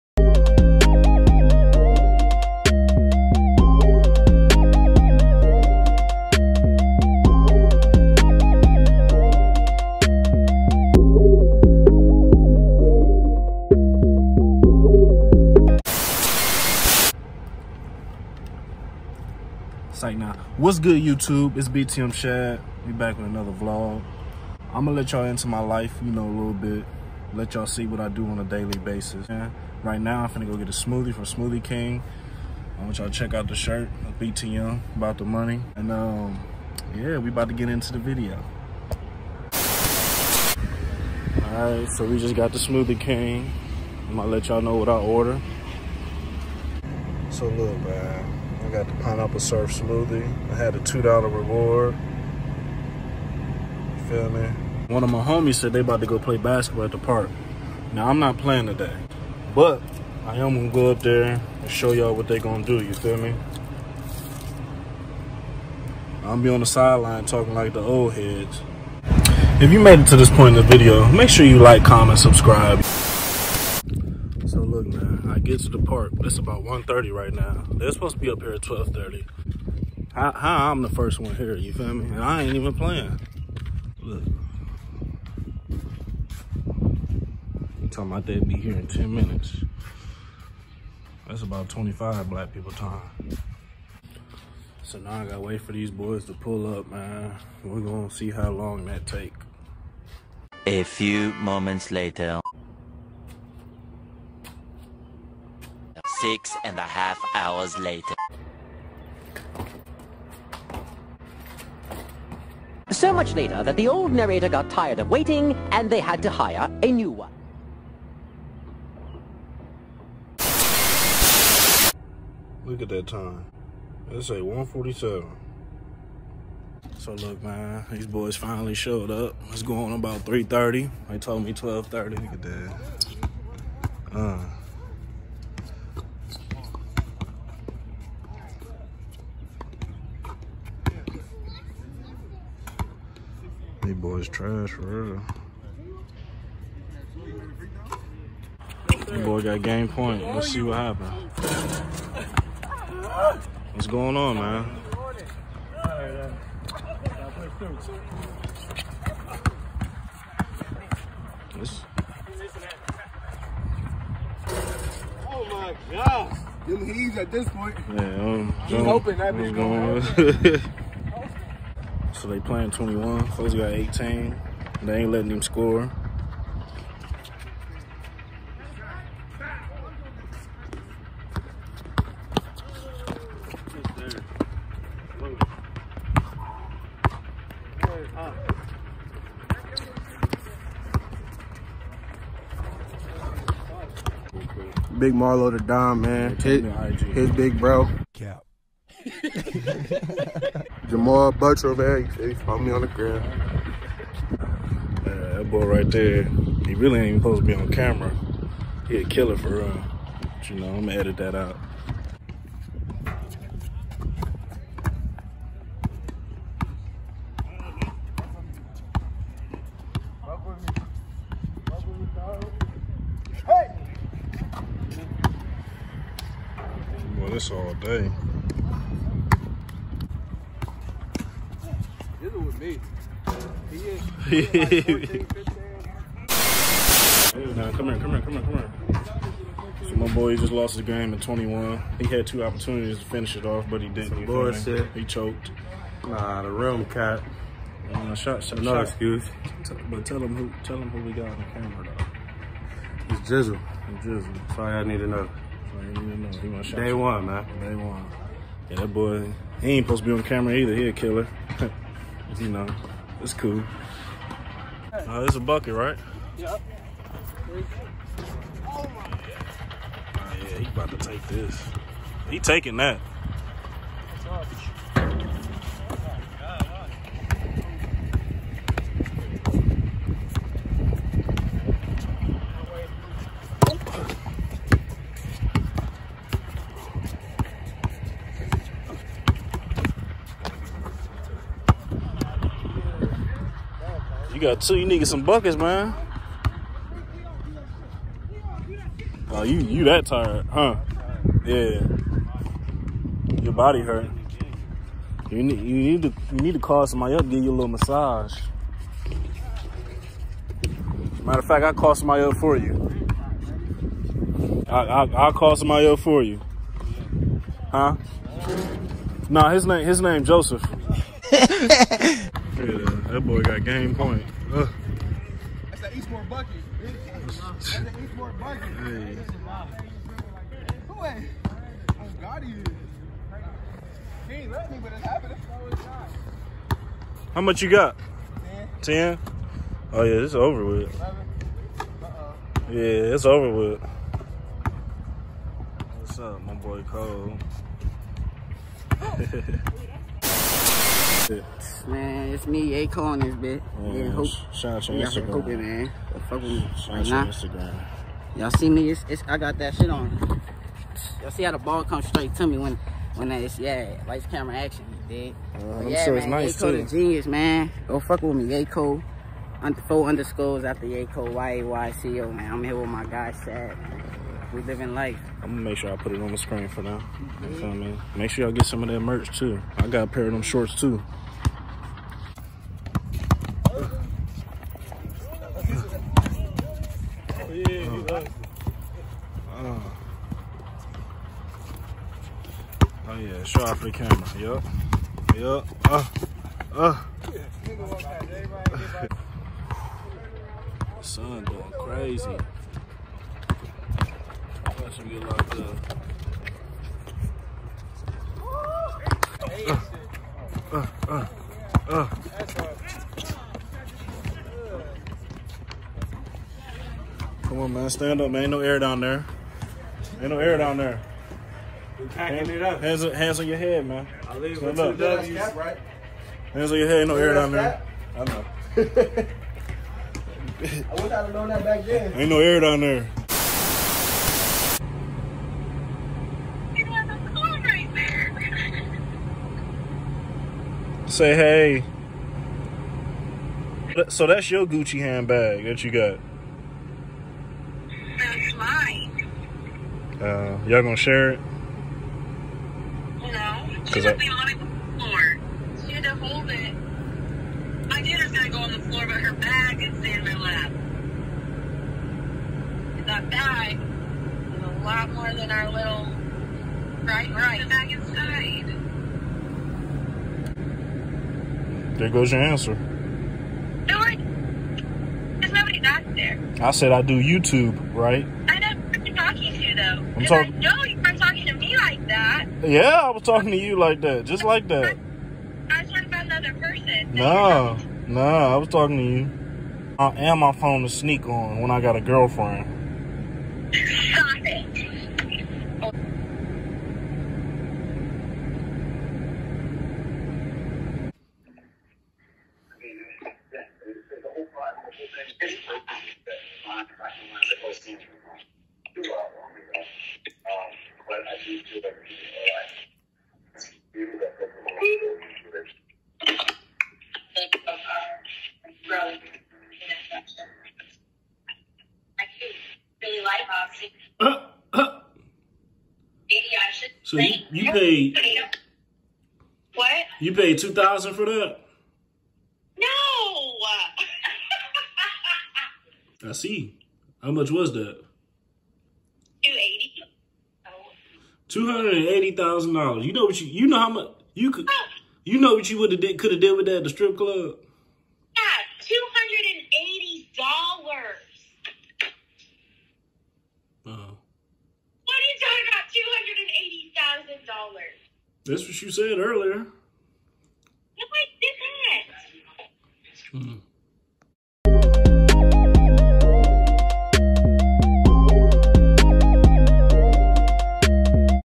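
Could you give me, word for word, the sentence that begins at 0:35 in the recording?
And um, yeah, we about to get into the video.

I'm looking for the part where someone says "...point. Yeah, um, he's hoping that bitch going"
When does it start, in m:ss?
2:47.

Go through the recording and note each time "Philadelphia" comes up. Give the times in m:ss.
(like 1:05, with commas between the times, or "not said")
not said.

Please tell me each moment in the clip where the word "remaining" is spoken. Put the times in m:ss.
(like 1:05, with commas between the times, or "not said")
not said.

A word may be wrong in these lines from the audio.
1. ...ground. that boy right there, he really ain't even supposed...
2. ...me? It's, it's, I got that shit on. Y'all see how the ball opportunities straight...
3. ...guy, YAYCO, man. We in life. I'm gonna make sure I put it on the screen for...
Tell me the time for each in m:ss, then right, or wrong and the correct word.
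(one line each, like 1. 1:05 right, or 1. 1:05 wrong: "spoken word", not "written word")
1. 3:22 right
2. 5:58 wrong: "comes", not "opportunities"
3. 6:13 wrong: "Shad", not "YAYCO".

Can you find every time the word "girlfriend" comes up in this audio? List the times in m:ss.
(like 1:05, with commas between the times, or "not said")
8:12.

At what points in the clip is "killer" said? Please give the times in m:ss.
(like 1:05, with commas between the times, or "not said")
3:29, 4:20.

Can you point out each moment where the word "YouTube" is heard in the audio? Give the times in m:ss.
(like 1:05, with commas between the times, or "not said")
0:21, 7:57.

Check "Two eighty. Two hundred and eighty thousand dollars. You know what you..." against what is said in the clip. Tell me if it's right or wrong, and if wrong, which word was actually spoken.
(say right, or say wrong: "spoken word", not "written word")
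right.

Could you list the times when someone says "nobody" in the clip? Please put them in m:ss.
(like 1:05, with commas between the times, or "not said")
7:55.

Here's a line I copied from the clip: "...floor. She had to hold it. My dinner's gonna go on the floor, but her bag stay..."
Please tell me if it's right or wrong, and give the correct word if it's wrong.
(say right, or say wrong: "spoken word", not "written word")
right.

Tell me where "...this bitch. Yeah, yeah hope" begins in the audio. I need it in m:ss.
5:53.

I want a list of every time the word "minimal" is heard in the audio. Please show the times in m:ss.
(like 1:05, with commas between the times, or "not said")
not said.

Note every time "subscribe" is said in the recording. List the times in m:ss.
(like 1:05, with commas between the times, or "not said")
1:12.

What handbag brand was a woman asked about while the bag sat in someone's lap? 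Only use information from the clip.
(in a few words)
Gucci.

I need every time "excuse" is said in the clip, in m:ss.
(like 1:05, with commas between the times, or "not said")
4:08.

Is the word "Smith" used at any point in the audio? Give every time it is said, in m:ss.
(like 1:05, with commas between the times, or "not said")
not said.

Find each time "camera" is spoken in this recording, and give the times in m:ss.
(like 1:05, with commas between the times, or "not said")
3:27, 4:11, 4:20, 6:04, 6:33.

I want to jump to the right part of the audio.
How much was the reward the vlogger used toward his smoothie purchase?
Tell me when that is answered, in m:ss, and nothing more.
0:50.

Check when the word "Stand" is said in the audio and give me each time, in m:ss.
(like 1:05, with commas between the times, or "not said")
6:57, 7:04.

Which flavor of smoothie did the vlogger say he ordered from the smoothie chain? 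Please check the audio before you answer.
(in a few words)
Pineapple surf.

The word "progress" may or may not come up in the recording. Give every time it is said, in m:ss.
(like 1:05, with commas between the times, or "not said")
not said.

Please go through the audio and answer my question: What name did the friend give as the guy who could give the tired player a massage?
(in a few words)
Joseph.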